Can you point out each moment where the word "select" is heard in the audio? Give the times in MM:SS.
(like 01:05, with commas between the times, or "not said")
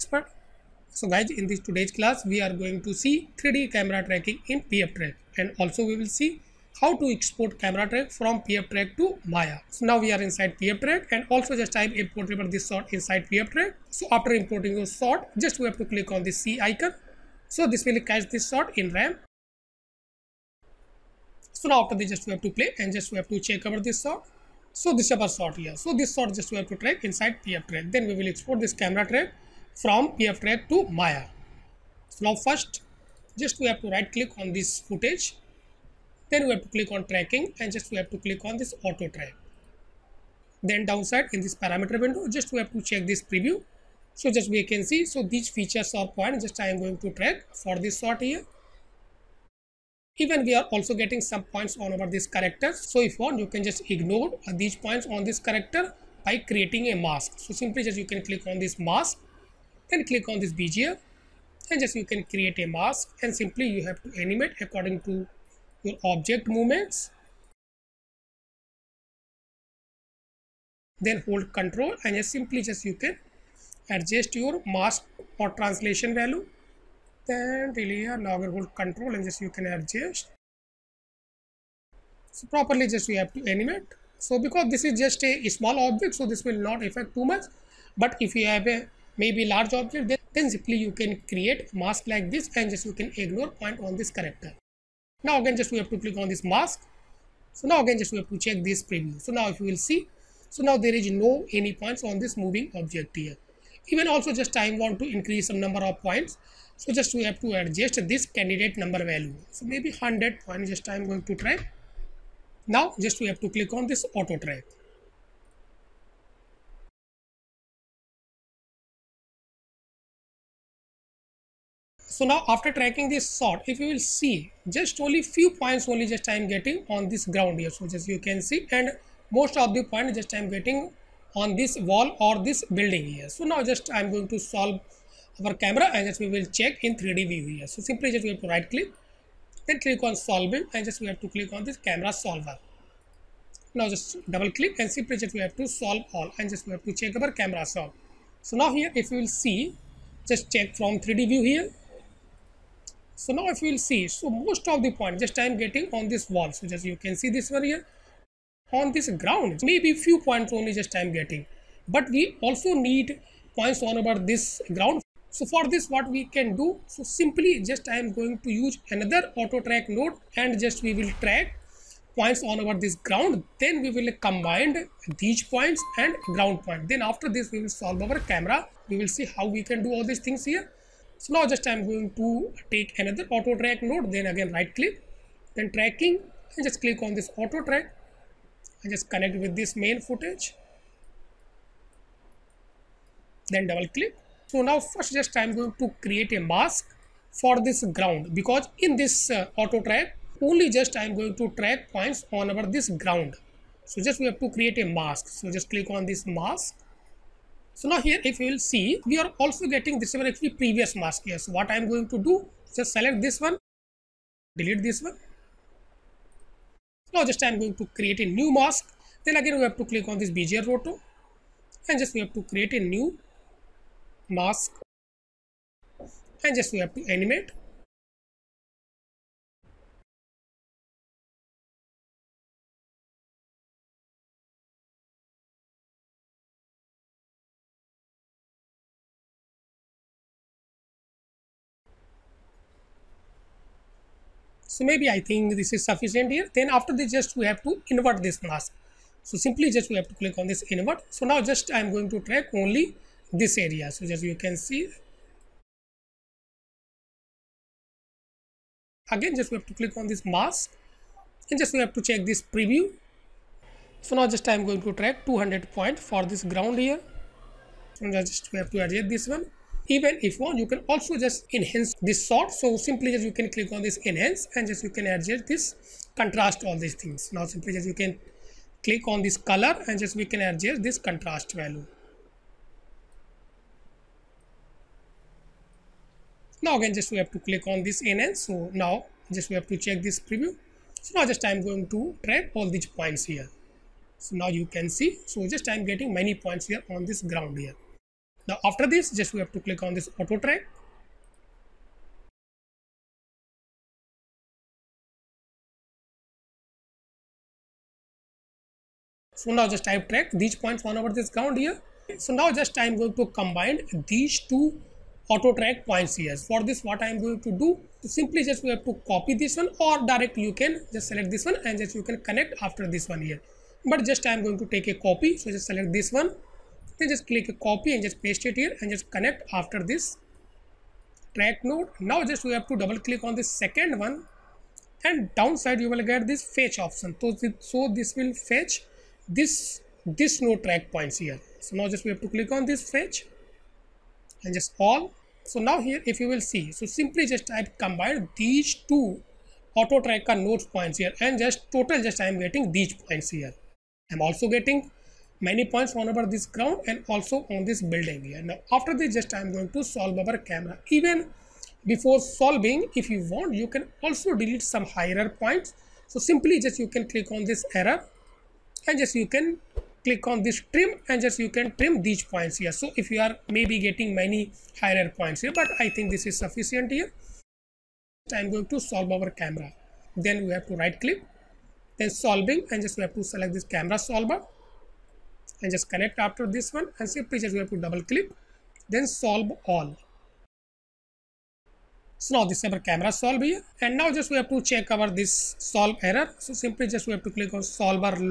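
03:32, 05:21, 05:25, 06:23.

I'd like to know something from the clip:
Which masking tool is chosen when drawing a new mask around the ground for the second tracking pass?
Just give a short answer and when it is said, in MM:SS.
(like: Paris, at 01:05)
Bezier Roto, at 03:40.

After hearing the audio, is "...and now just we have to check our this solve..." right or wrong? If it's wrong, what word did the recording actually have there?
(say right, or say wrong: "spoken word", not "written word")
right.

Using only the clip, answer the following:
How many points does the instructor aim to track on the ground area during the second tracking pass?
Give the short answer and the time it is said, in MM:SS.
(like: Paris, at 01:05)
200, at 04:25.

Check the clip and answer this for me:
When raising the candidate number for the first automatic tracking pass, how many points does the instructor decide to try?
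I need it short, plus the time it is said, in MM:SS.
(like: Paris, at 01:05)
100, at 01:49.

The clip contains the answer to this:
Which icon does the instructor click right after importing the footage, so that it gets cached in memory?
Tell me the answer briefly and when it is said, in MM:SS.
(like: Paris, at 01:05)
C icon, at 00:16.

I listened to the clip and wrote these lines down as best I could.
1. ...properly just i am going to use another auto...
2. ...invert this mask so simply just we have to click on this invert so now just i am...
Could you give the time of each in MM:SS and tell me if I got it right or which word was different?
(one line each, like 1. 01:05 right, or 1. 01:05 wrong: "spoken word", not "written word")
1. 02:47 wrong: "simply", not "properly"
2. 04:07 right.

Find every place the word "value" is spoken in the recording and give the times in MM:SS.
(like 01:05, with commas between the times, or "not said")
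01:16, 01:49, 04:41.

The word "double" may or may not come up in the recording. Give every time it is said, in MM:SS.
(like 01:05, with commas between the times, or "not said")
02:24, 03:13, 05:32, 06:27.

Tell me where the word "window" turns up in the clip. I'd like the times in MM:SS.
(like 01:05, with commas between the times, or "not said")
00:42.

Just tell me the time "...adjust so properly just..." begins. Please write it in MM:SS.
01:19.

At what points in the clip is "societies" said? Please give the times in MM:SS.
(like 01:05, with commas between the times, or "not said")
not said.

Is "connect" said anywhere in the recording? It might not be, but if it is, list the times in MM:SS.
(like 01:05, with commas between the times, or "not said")
03:09, 05:22, 05:29, 06:25.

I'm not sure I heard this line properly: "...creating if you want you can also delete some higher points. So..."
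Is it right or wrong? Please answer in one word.
wrong.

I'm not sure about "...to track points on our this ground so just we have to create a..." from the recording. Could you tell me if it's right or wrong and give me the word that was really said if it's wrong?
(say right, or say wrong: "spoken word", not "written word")
right.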